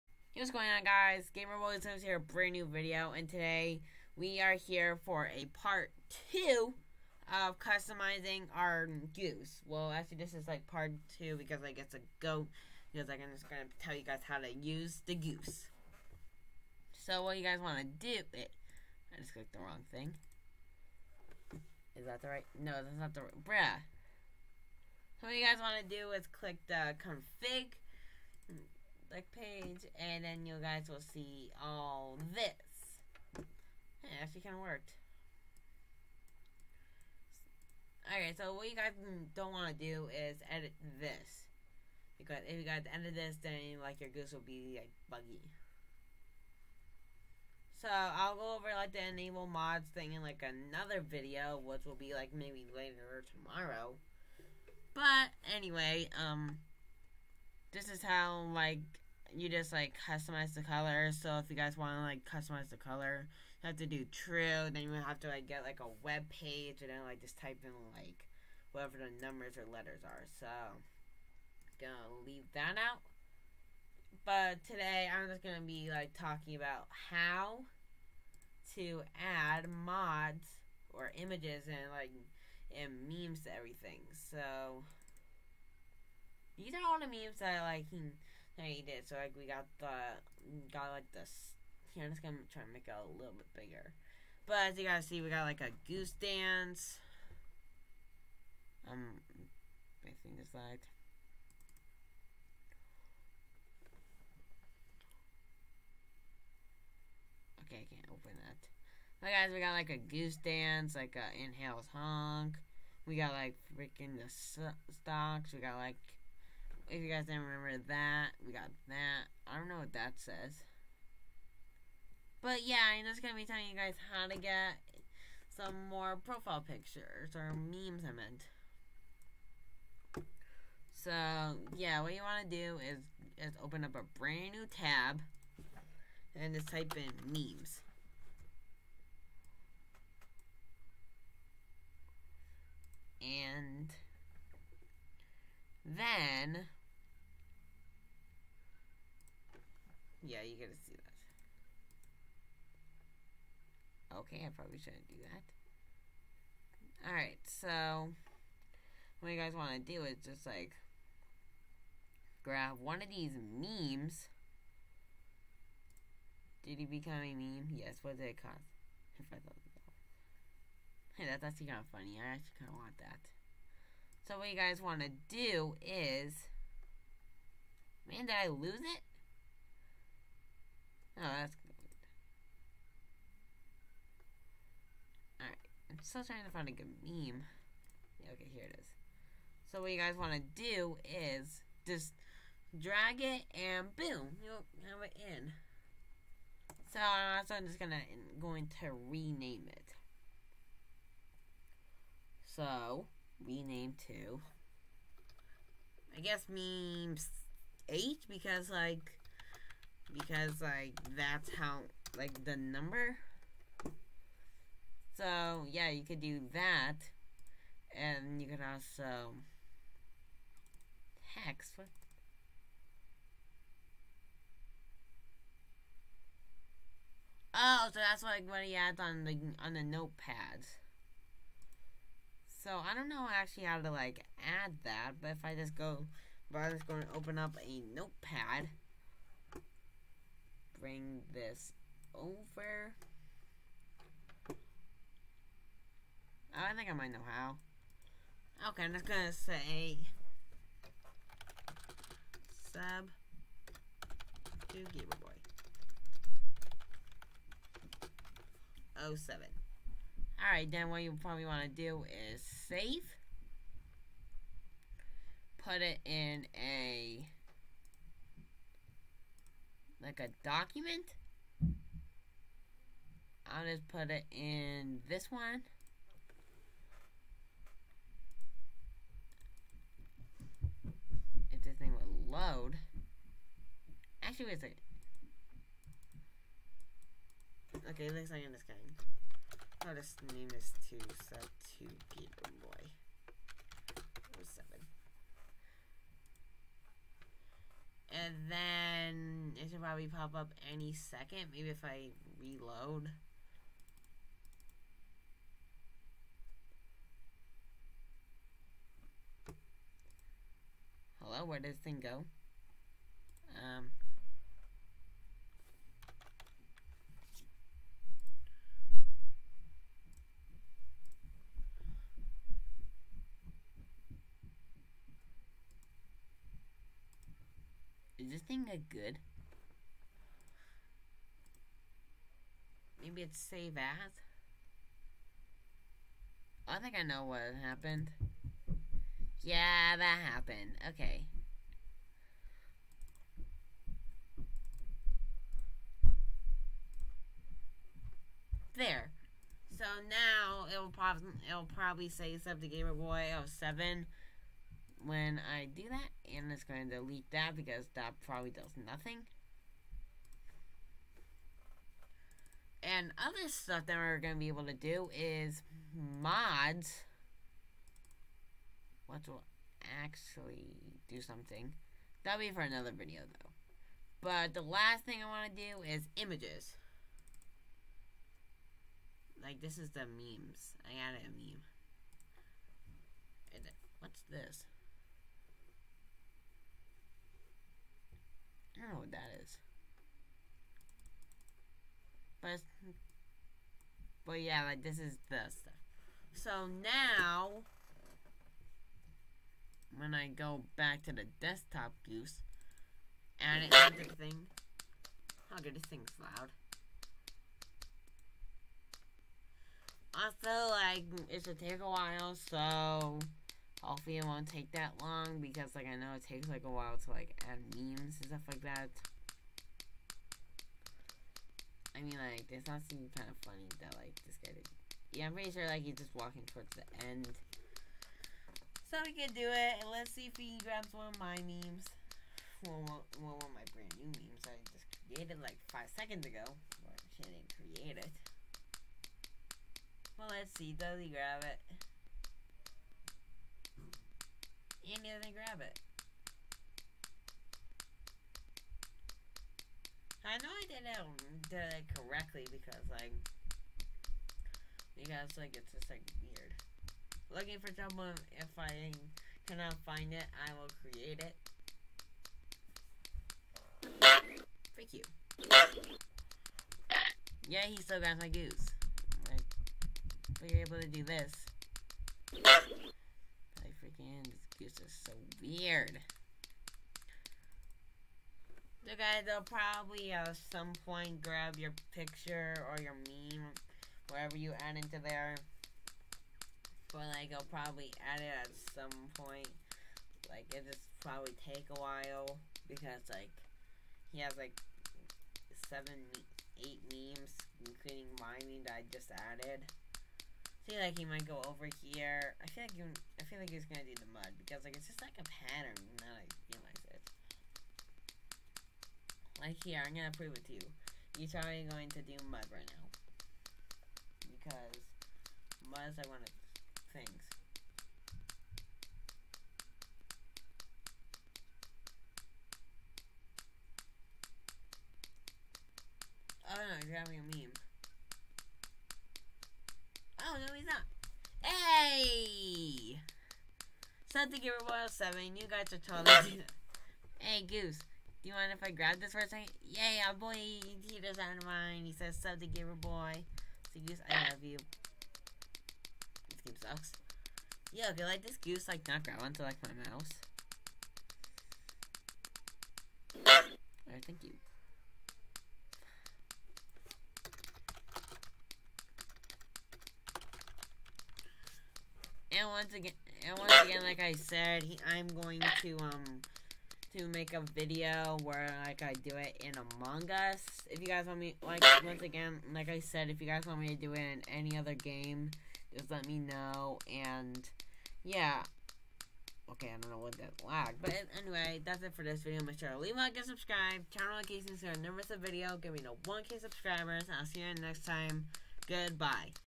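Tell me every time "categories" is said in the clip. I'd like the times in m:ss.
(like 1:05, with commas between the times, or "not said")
not said.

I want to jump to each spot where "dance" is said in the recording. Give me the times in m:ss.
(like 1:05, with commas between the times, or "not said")
1:36, 1:50.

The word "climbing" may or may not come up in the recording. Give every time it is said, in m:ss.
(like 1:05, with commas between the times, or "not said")
not said.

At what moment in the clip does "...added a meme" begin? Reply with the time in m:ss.
6:21.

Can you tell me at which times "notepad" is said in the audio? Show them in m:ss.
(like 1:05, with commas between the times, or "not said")
3:49, 3:57.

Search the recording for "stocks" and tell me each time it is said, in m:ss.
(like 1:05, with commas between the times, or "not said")
1:54.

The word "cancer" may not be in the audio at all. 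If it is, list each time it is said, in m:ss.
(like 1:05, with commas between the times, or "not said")
not said.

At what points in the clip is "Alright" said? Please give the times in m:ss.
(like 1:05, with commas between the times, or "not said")
0:38, 2:37, 3:05, 4:20, 9:13.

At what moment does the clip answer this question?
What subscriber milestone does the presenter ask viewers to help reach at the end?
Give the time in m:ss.
9:46.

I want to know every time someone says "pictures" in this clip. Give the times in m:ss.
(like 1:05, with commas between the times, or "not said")
2:06, 8:01.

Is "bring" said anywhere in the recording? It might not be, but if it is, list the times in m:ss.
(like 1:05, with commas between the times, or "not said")
4:00.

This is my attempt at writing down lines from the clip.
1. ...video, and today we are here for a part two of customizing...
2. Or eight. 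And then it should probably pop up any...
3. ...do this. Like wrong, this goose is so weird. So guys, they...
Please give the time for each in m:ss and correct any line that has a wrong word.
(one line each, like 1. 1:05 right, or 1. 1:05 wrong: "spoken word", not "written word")
1. 0:02 right
2. 4:53 wrong: "seven", not "eight"
3. 7:50 wrong: "freaking", not "wrong".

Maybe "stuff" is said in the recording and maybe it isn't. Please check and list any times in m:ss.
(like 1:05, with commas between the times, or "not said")
6:03, 6:35, 6:58.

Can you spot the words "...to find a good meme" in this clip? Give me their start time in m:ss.
3:06.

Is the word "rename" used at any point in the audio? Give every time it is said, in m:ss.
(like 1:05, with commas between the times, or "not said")
3:19, 3:23.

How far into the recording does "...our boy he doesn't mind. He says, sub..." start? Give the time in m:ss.
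9:00.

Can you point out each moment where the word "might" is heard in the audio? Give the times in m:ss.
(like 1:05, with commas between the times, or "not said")
4:06, 8:21.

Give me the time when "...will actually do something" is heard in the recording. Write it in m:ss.
6:09.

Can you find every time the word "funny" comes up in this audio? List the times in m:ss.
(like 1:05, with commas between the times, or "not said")
2:51, 7:03.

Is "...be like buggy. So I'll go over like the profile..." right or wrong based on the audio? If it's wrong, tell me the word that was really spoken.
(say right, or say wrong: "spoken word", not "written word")
wrong: "enable", not "profile".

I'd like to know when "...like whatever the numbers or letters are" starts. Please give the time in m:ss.
1:07.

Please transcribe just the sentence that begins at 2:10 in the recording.
So, yeah, what you want to do is, is open up a brand new tab and just type in memes.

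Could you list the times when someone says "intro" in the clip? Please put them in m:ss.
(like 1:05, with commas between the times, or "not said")
not said.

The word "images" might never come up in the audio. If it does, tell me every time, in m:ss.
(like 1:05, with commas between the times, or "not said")
1:21, 6:16.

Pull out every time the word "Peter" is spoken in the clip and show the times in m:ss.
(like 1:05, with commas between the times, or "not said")
4:52.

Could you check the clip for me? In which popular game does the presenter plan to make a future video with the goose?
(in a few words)
Among Us.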